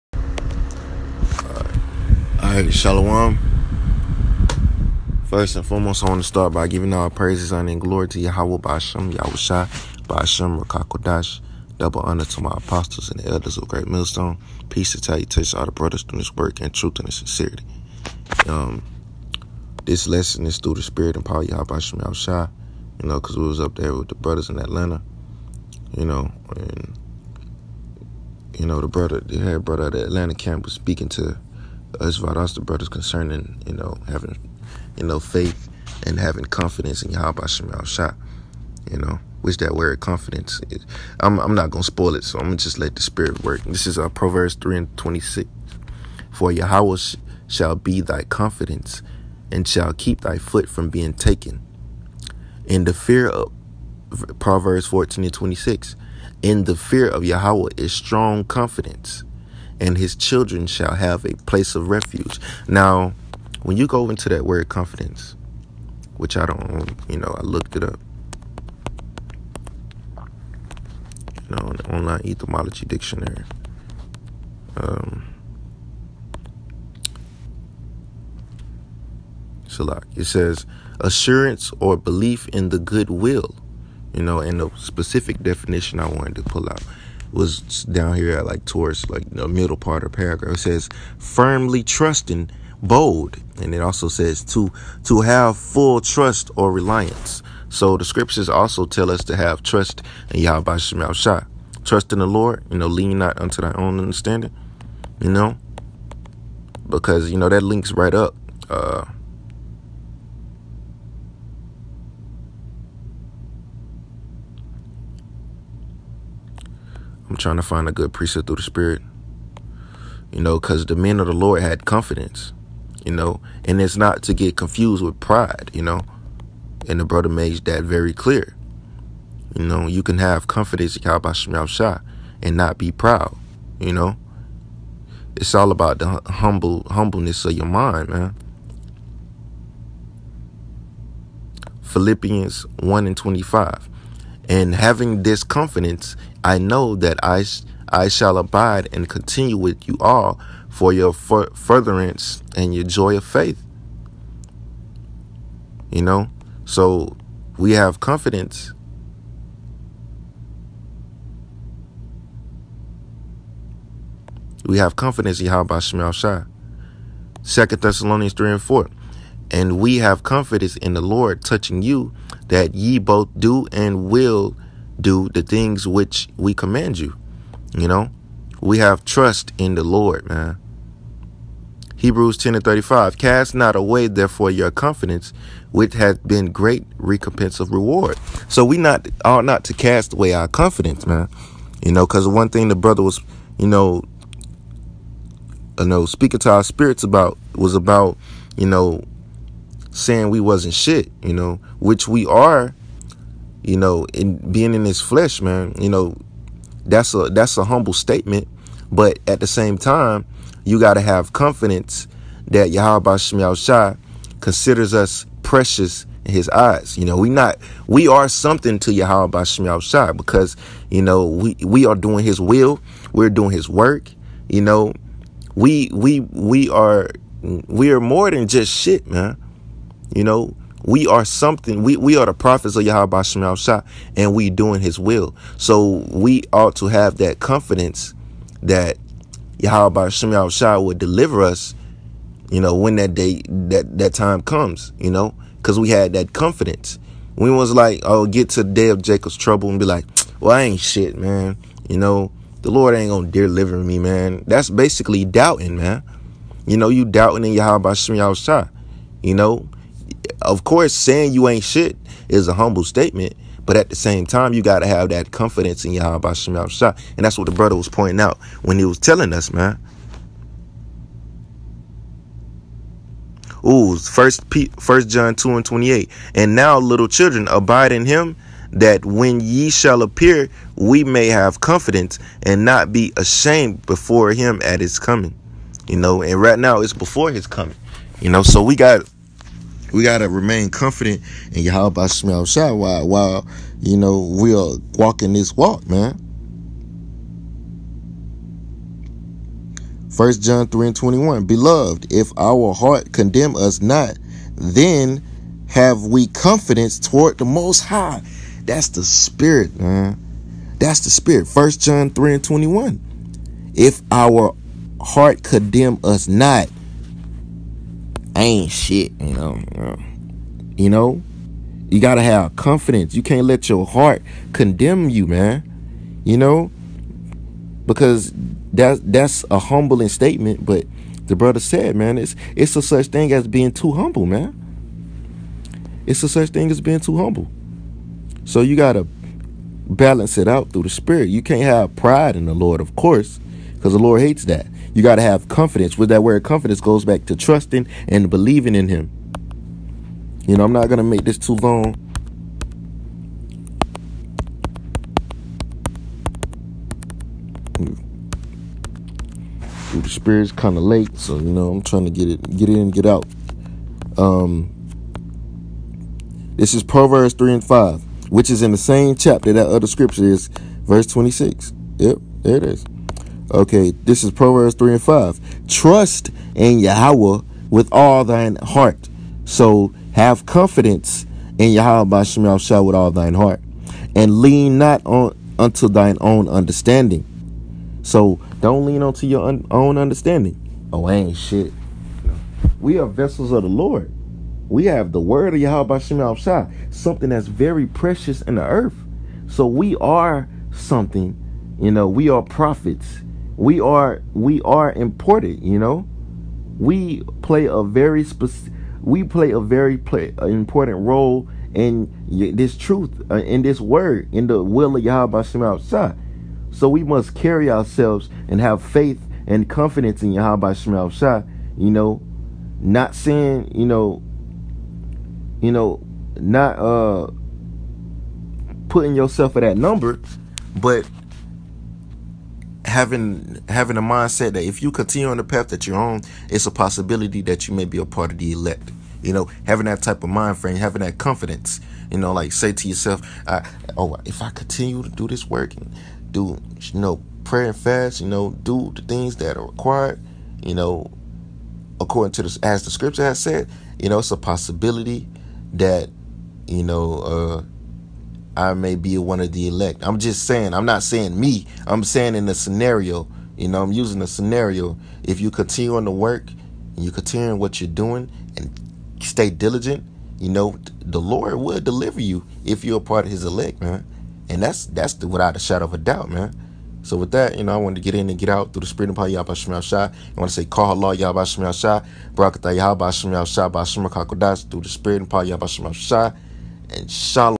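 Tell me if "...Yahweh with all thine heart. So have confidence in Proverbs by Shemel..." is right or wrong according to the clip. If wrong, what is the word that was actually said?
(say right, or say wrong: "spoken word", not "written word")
wrong: "Yahweh", not "Proverbs".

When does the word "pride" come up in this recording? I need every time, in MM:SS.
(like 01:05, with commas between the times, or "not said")
02:05, 05:41.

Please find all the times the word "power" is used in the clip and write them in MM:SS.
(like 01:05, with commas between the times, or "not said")
00:21, 07:59, 08:05.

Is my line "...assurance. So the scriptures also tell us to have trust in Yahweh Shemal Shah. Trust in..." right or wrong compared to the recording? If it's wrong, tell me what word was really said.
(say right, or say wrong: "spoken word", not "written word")
wrong: "reliance", not "assurance".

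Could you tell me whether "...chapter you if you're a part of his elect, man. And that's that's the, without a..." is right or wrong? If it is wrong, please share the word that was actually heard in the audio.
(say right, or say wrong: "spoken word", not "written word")
wrong: "deliver", not "chapter".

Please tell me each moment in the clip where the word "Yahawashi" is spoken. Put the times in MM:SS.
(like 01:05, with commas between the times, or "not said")
00:09.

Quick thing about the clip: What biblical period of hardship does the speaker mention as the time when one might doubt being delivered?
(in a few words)
the day of Jacob's trouble.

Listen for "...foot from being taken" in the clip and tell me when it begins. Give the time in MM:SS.
00:50.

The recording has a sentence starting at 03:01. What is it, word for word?
Hebrews 10 and 35 Cast not away, therefore, your confidence, which hath been great recompense of reward.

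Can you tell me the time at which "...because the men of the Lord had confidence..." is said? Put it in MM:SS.
02:00.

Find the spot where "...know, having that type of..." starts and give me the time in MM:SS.
07:19.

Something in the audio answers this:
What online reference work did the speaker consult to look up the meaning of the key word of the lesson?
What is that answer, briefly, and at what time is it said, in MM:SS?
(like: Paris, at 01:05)
online etymology dictionary, at 01:11.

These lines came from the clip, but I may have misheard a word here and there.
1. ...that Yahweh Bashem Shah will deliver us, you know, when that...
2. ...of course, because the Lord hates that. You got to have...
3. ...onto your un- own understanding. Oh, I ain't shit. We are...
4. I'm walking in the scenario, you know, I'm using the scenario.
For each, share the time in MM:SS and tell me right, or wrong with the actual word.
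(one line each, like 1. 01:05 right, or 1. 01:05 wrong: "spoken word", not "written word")
1. 03:58 right
2. 05:42 right
3. 06:29 right
4. 07:41 wrong: "saying", not "walking".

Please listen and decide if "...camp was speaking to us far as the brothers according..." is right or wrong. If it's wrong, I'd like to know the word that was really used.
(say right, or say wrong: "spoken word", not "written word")
wrong: "concerning", not "according".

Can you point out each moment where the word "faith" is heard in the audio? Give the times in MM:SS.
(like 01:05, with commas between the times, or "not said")
00:35, 02:33, 06:58.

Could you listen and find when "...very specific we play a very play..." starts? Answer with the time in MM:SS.
06:47.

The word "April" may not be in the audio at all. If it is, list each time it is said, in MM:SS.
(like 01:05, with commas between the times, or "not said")
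not said.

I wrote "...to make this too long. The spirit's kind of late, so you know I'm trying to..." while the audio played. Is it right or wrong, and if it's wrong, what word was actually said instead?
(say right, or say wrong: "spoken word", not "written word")
right.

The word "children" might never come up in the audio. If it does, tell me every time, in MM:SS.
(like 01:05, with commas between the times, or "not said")
01:00, 04:37.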